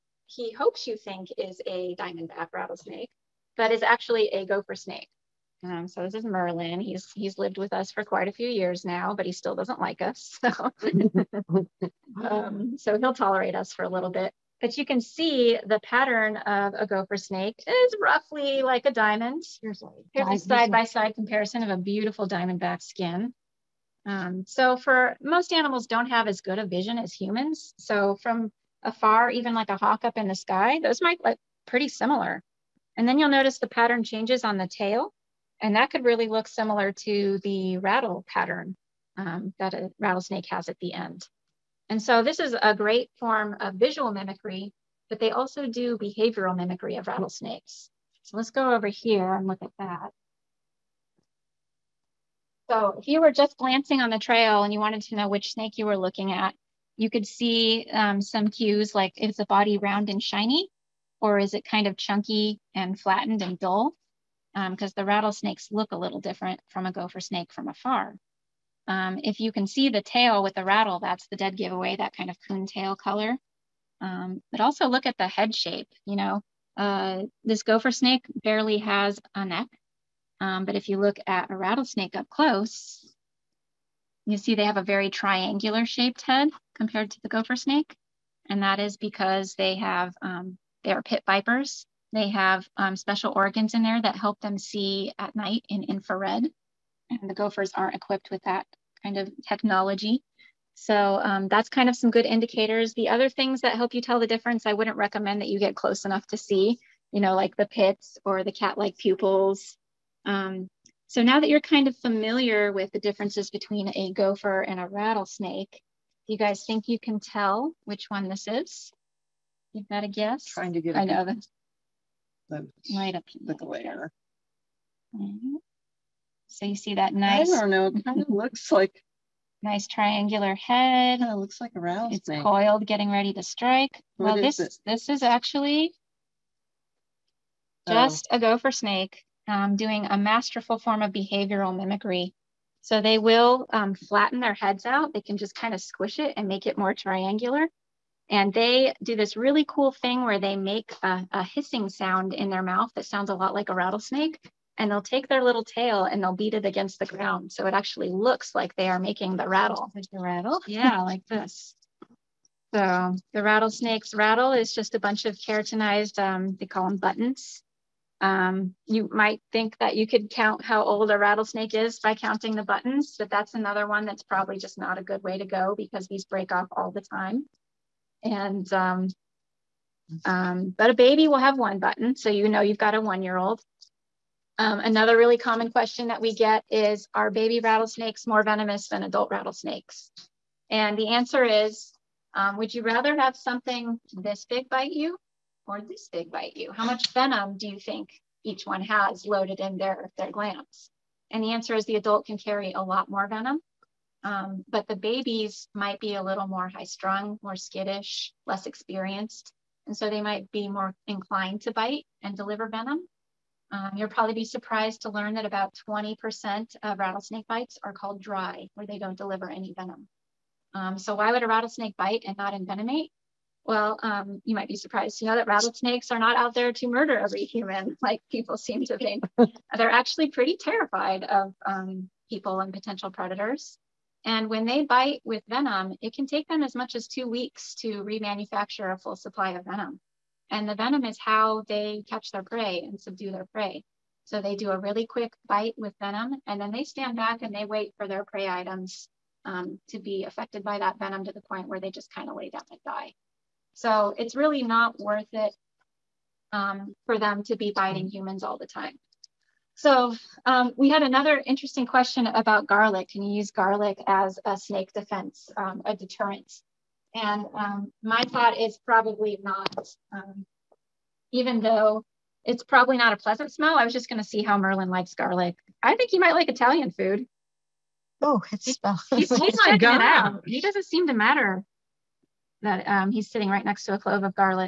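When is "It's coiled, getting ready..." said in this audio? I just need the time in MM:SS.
02:12.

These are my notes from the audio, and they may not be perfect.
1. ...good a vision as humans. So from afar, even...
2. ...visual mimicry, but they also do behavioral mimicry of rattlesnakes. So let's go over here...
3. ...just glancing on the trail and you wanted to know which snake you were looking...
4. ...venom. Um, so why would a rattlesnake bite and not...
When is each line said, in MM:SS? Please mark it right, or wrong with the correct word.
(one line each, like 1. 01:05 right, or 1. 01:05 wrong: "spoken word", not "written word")
1. 00:26 right
2. 00:43 right
3. 00:53 right
4. 03:39 right.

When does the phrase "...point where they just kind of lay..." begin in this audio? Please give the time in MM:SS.
04:11.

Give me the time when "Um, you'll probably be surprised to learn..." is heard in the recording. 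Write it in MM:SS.
03:33.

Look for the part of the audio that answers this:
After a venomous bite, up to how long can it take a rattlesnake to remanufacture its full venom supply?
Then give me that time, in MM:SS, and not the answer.
03:57.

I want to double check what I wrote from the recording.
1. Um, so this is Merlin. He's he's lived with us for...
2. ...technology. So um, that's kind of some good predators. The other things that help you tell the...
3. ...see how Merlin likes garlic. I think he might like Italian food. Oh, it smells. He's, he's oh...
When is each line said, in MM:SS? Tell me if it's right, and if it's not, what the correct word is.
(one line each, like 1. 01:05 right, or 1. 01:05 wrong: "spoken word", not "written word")
1. 00:05 right
2. 01:39 wrong: "indicators", not "predators"
3. 04:34 right.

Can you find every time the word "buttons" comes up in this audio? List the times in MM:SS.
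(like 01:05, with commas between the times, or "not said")
02:46, 02:52, 03:01.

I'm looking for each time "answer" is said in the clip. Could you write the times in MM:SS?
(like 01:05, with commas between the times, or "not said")
03:11, 03:21.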